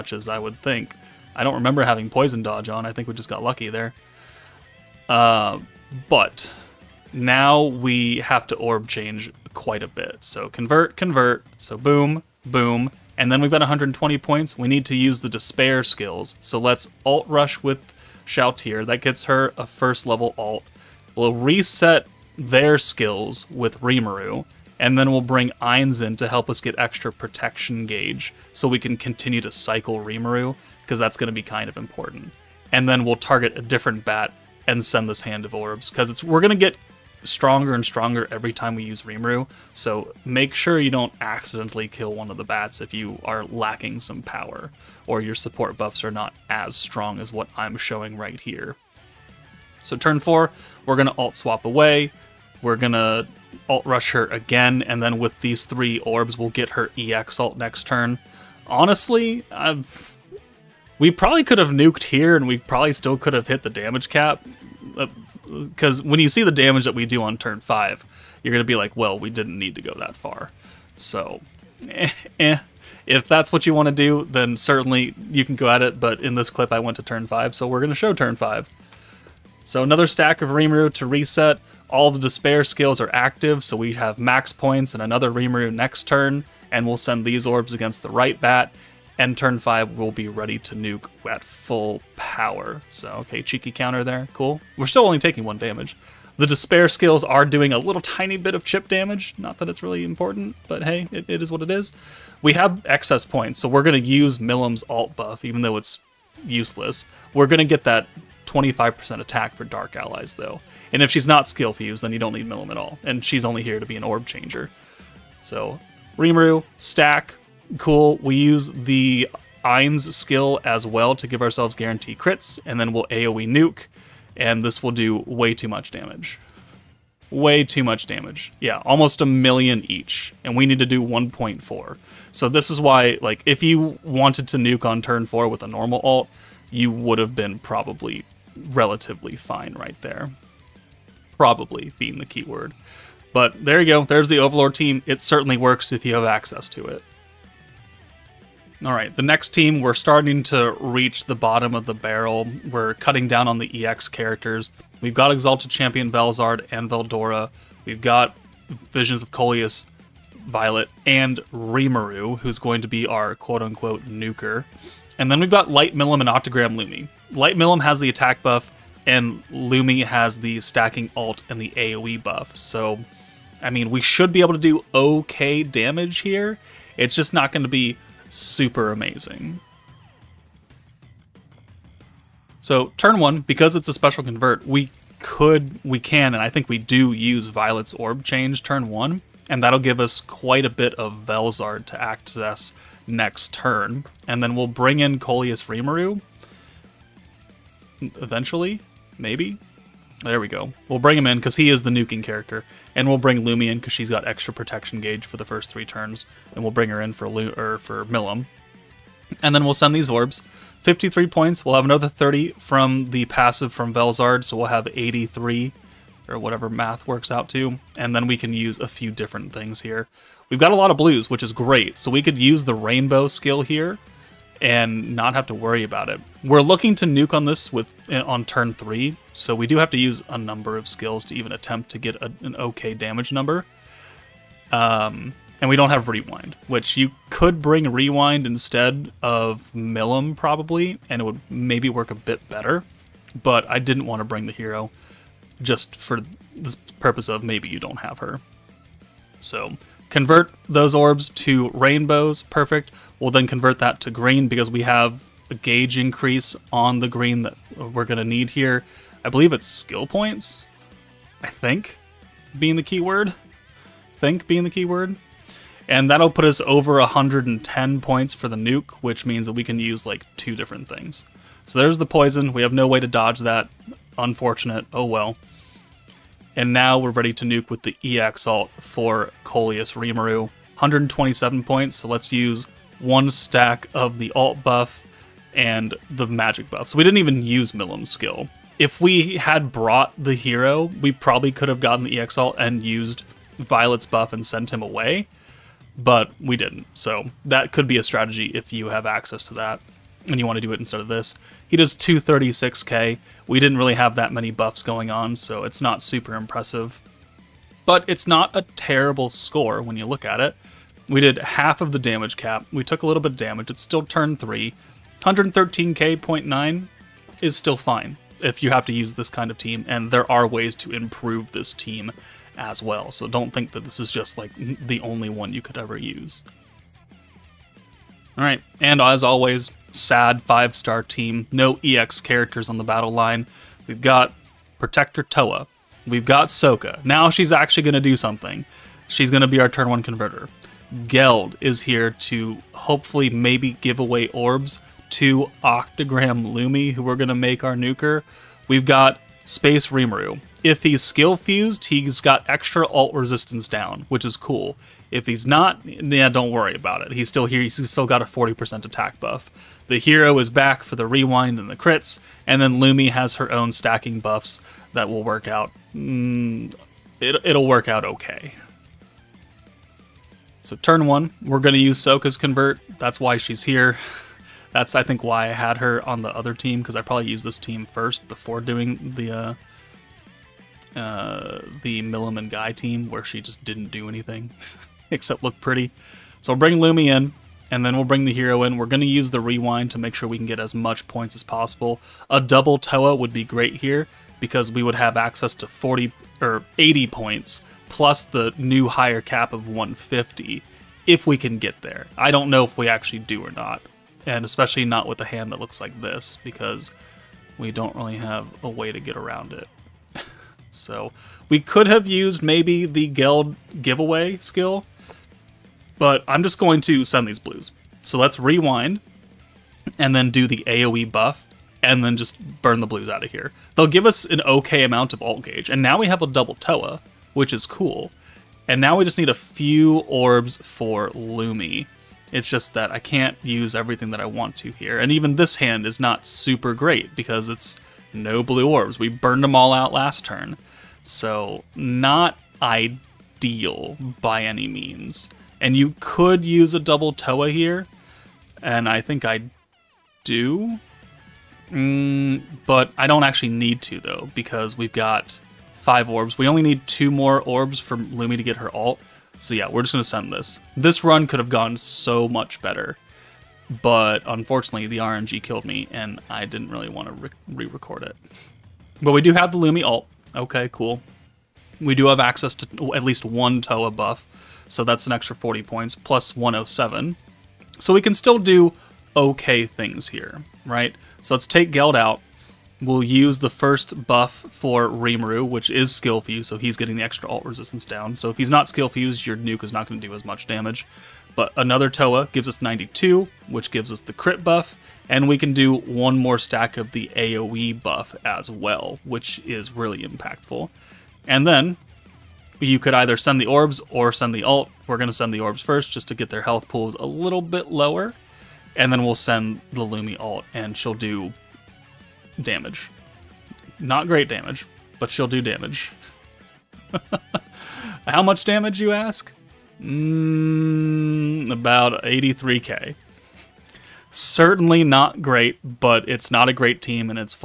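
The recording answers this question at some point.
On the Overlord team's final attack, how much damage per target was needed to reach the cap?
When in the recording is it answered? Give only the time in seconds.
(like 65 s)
131 s.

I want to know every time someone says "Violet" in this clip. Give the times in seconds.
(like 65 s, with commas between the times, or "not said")
160 s, 187 s, 293 s.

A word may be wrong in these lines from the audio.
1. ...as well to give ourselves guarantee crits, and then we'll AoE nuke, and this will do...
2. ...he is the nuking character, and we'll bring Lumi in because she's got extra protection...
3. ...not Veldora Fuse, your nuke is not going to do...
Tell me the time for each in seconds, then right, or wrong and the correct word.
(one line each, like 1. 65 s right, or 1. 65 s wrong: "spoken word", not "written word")
1. 120 s right
2. 201 s right
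3. 488 s wrong: "Skill", not "Veldora".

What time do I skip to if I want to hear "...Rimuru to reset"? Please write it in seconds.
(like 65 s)
80 s.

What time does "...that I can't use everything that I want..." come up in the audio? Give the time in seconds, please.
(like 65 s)
432 s.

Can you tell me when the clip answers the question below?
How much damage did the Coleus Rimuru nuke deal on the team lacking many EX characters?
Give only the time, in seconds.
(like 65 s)
301 s.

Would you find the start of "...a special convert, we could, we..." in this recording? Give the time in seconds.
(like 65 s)
183 s.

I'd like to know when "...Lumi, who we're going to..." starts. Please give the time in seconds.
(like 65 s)
346 s.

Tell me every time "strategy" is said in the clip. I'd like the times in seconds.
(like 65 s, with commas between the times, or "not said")
298 s.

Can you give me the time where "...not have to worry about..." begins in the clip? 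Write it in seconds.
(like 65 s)
225 s.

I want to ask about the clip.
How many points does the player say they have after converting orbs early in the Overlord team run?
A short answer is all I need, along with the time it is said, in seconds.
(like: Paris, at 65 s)
120, at 13 s.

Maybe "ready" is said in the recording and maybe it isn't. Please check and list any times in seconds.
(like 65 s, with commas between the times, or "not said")
90 s, 277 s.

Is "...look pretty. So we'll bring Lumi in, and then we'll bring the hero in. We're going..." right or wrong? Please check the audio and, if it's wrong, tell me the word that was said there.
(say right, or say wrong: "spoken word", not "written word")
right.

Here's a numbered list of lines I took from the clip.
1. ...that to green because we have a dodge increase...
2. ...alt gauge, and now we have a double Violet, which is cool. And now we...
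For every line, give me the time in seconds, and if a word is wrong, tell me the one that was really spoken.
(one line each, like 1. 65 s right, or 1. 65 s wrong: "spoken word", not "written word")
1. 253 s wrong: "gauge", not "dodge"
2. 425 s wrong: "Towa", not "Violet".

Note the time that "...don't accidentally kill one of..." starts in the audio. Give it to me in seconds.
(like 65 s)
40 s.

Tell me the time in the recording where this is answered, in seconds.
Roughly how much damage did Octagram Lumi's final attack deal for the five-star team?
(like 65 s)
522 s.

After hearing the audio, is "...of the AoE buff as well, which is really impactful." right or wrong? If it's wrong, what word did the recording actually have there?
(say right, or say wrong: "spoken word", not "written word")
right.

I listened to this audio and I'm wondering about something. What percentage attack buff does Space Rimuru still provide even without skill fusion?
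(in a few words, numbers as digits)
40%.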